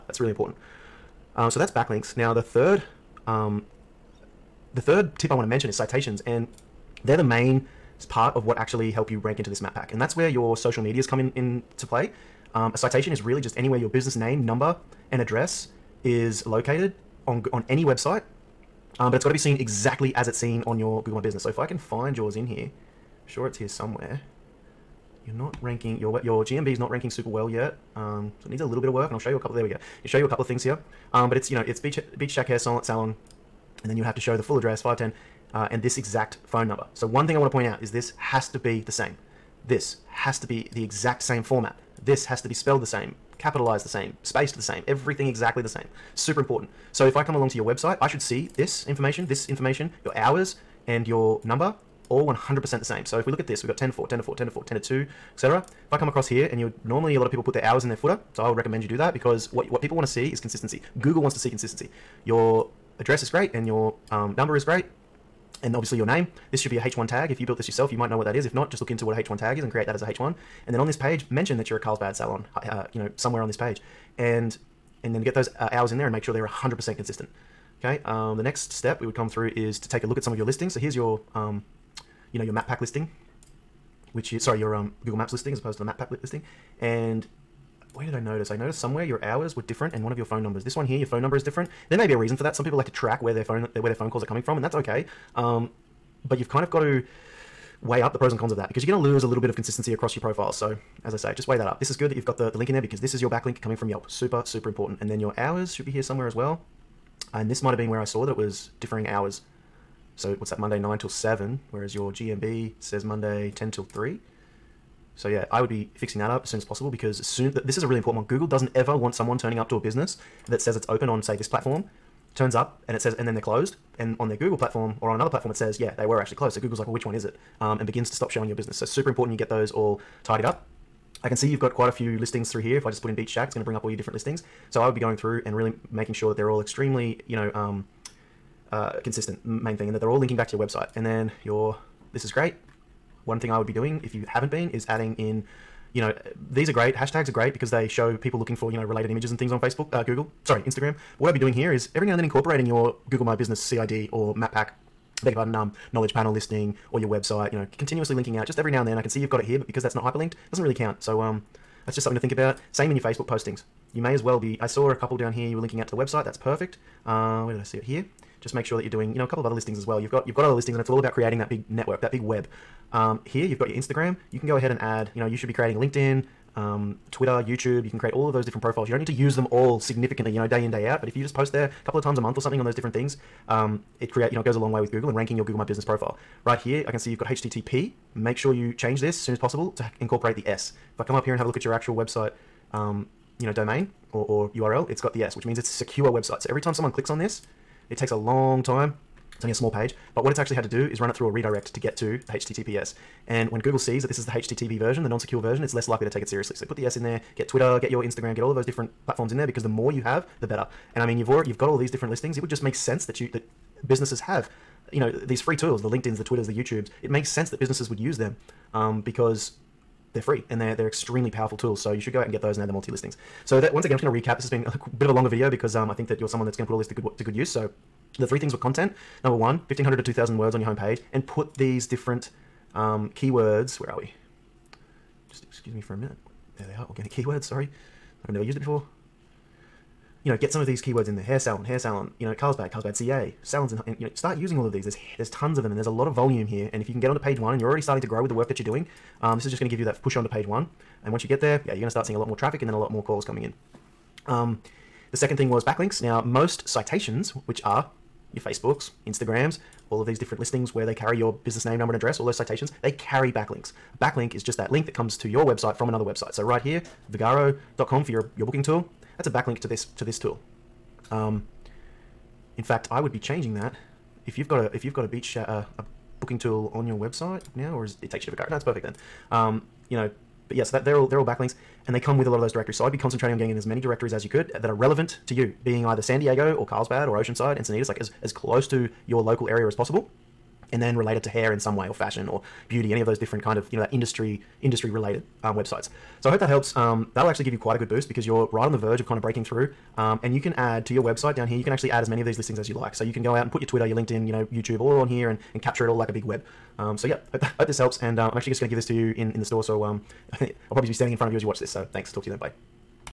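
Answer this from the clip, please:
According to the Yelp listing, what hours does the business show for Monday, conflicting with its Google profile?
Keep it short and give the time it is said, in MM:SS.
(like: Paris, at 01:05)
9 till 7, at 01:50.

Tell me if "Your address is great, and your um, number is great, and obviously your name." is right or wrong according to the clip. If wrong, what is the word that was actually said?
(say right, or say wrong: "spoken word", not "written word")
right.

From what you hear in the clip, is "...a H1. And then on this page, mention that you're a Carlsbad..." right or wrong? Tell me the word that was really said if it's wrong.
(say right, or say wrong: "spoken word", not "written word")
right.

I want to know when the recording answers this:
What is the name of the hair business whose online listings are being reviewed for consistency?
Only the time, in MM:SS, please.
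00:31.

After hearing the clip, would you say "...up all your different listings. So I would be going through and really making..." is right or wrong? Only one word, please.
right.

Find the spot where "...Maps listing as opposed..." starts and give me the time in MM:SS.
01:25.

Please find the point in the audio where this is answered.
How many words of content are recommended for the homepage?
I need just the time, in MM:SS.
03:49.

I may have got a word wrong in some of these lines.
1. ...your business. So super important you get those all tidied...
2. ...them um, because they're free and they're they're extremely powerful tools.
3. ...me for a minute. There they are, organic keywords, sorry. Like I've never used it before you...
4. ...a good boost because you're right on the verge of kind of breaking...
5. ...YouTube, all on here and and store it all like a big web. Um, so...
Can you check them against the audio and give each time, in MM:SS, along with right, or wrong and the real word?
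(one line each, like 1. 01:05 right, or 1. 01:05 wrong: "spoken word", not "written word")
1. 02:08 right
2. 03:38 right
3. 03:55 right
4. 04:57 right
5. 05:04 wrong: "capture", not "store".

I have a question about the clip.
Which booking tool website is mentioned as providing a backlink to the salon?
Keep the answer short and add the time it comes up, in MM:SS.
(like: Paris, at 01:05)
Vagaro, at 04:27.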